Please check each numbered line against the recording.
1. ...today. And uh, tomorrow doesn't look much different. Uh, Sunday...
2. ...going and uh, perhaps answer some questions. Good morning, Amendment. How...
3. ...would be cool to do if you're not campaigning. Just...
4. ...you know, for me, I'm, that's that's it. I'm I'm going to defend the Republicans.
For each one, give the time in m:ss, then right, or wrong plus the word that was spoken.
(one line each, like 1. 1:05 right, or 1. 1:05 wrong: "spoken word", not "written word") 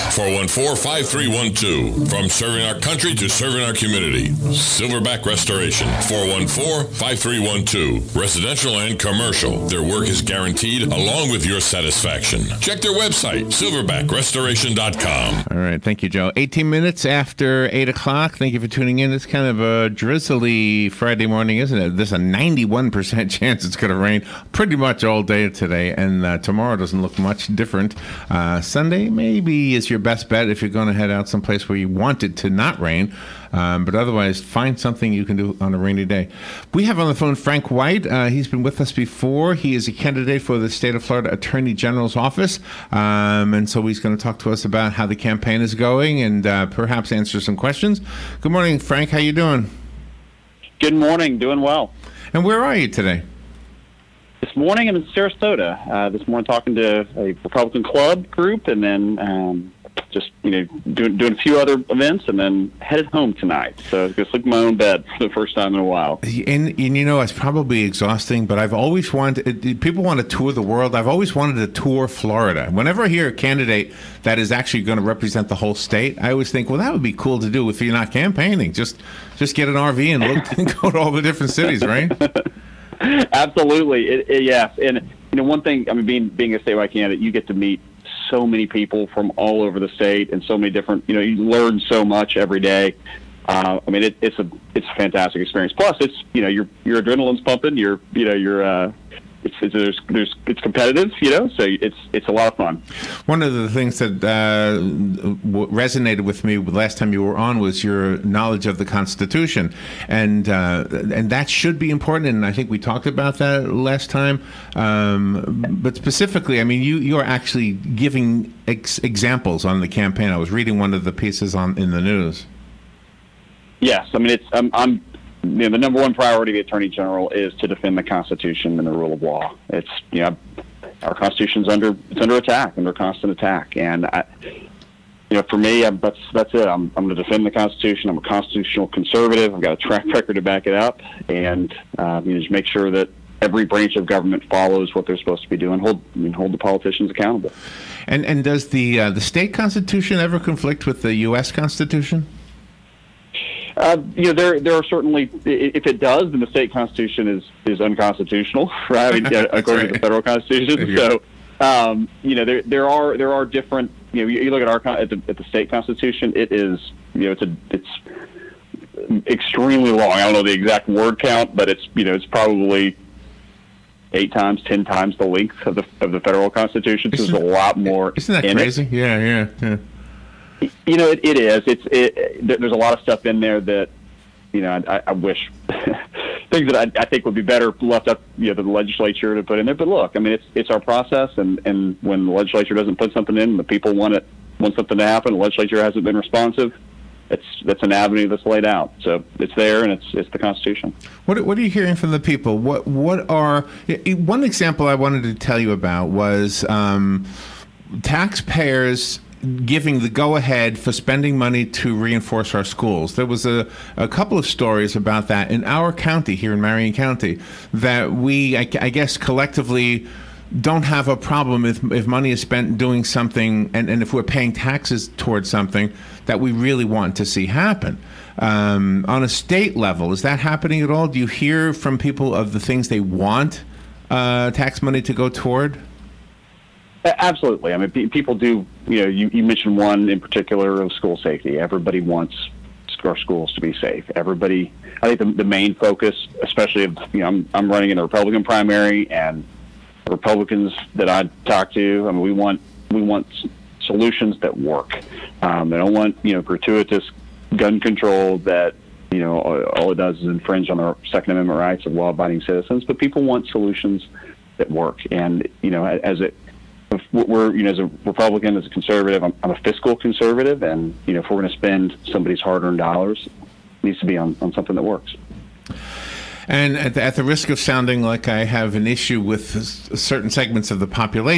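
1. 0:25 right
2. 0:45 wrong: "Frank", not "Amendment"
3. 1:16 right
4. 2:14 wrong: "Constitution", not "Republicans".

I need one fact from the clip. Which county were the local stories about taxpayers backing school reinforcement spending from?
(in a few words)
Marion County.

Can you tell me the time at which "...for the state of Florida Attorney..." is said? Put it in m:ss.
0:40.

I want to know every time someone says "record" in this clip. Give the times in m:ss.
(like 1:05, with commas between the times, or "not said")
2:20.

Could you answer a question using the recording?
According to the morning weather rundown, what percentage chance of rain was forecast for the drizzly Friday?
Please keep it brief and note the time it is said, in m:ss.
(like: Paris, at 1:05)
91%, at 0:22.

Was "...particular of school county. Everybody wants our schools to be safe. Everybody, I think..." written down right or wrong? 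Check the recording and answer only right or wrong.
wrong.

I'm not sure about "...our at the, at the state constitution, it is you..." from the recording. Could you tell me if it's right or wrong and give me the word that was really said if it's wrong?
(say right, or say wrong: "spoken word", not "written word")
right.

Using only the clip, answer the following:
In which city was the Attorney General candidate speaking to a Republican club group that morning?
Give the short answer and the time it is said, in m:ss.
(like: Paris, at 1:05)
Sarasota, at 0:55.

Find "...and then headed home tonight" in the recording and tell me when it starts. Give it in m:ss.
1:02.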